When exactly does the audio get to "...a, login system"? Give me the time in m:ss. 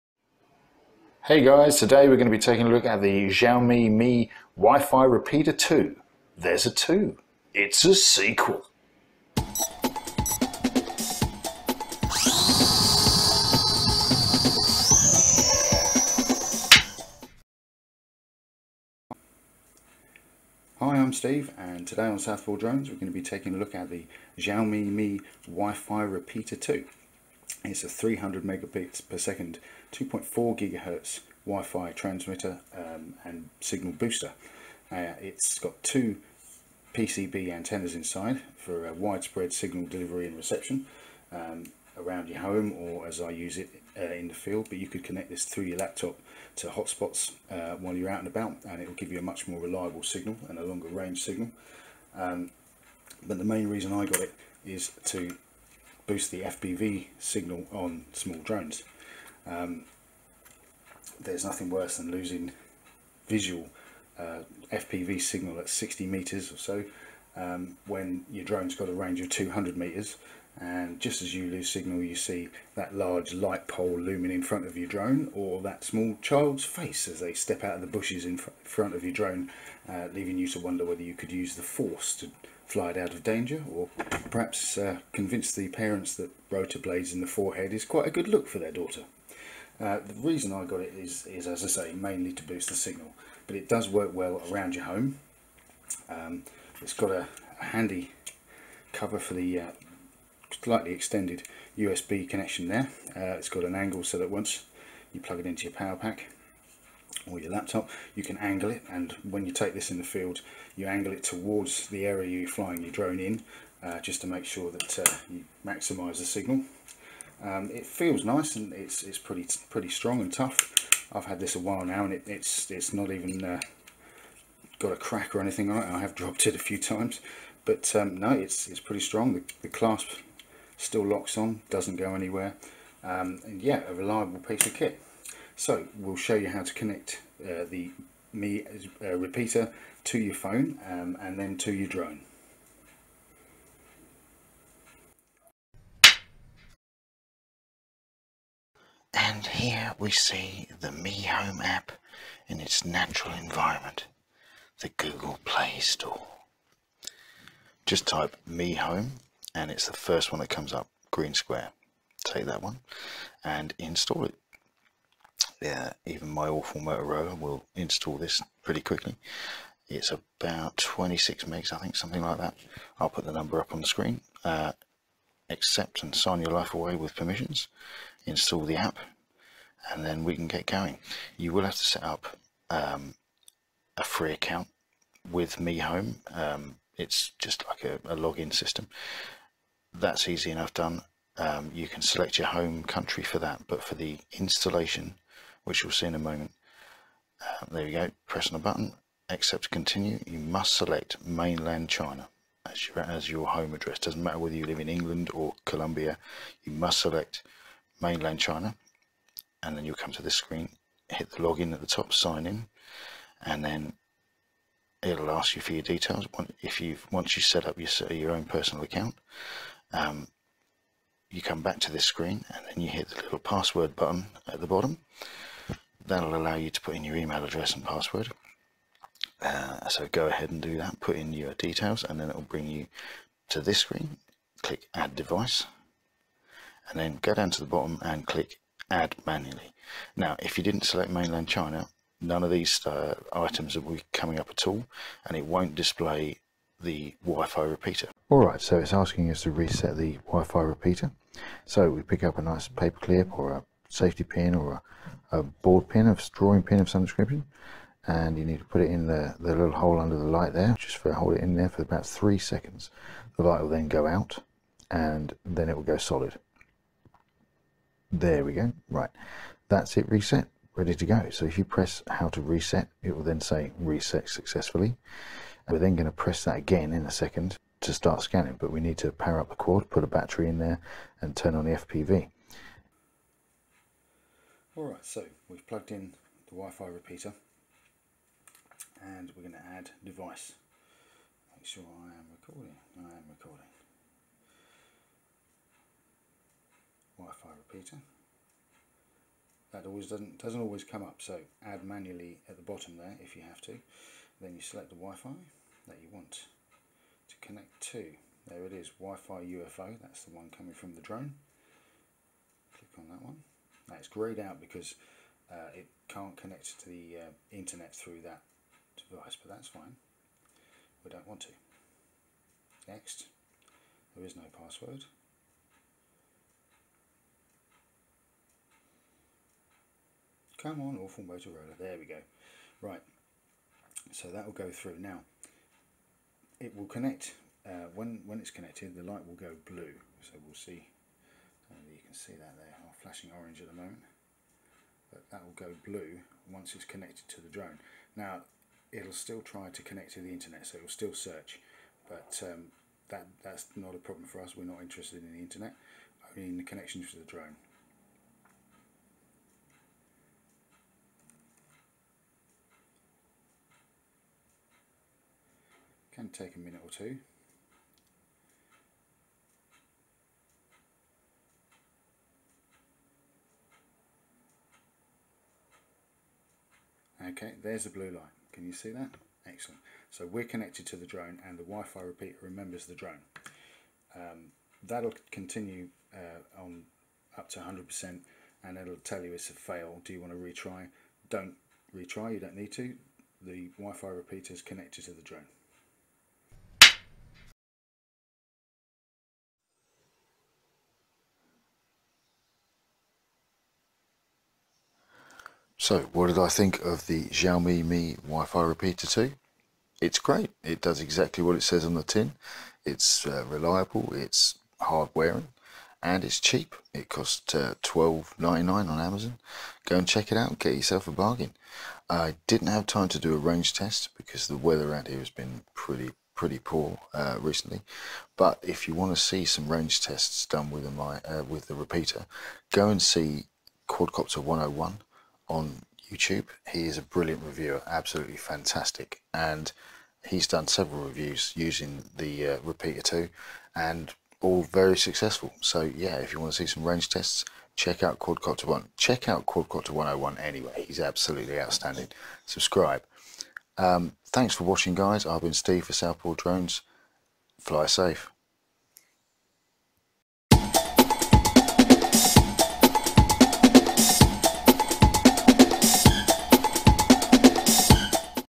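3:08.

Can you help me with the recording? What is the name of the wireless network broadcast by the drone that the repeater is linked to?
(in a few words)
Wi-Fi UFO.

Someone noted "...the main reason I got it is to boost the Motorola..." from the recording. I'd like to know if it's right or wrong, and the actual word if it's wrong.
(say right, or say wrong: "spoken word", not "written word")
wrong: "FPV", not "Motorola".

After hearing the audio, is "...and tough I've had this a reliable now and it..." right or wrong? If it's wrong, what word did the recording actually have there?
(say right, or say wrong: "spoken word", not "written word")
wrong: "while", not "reliable".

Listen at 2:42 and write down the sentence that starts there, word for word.
Take that one and install it yeah, even my awful Motorola will install this pretty quickly.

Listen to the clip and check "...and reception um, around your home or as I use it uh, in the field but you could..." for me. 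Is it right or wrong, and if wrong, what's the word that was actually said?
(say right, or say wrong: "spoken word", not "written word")
right.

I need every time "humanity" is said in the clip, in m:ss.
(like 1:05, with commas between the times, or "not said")
not said.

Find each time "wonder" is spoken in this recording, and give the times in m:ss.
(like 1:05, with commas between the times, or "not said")
1:20.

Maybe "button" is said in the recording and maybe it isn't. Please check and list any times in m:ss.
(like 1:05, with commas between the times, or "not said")
3:18, 3:43.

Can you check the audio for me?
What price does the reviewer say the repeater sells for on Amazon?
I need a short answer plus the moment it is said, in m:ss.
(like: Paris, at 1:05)
$12.99, at 6:57.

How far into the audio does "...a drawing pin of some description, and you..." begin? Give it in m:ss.
4:16.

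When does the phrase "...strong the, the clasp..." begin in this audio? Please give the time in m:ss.
2:09.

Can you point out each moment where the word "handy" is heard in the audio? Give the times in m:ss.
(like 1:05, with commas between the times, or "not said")
1:37.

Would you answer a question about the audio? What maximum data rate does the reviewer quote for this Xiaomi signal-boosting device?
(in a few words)
300 megabits per second.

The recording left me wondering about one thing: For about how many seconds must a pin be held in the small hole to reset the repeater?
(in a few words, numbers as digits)
3 seconds.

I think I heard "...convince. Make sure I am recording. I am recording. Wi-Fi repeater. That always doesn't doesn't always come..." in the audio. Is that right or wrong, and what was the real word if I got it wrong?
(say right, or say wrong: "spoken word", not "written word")
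wrong: "device", not "convince".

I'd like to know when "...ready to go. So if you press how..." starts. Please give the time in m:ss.
4:30.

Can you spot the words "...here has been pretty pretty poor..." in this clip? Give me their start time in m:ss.
7:05.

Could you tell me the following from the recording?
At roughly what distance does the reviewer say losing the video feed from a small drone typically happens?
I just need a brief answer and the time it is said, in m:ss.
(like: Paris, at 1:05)
60 meters, at 1:05.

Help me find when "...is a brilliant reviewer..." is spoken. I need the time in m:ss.
7:16.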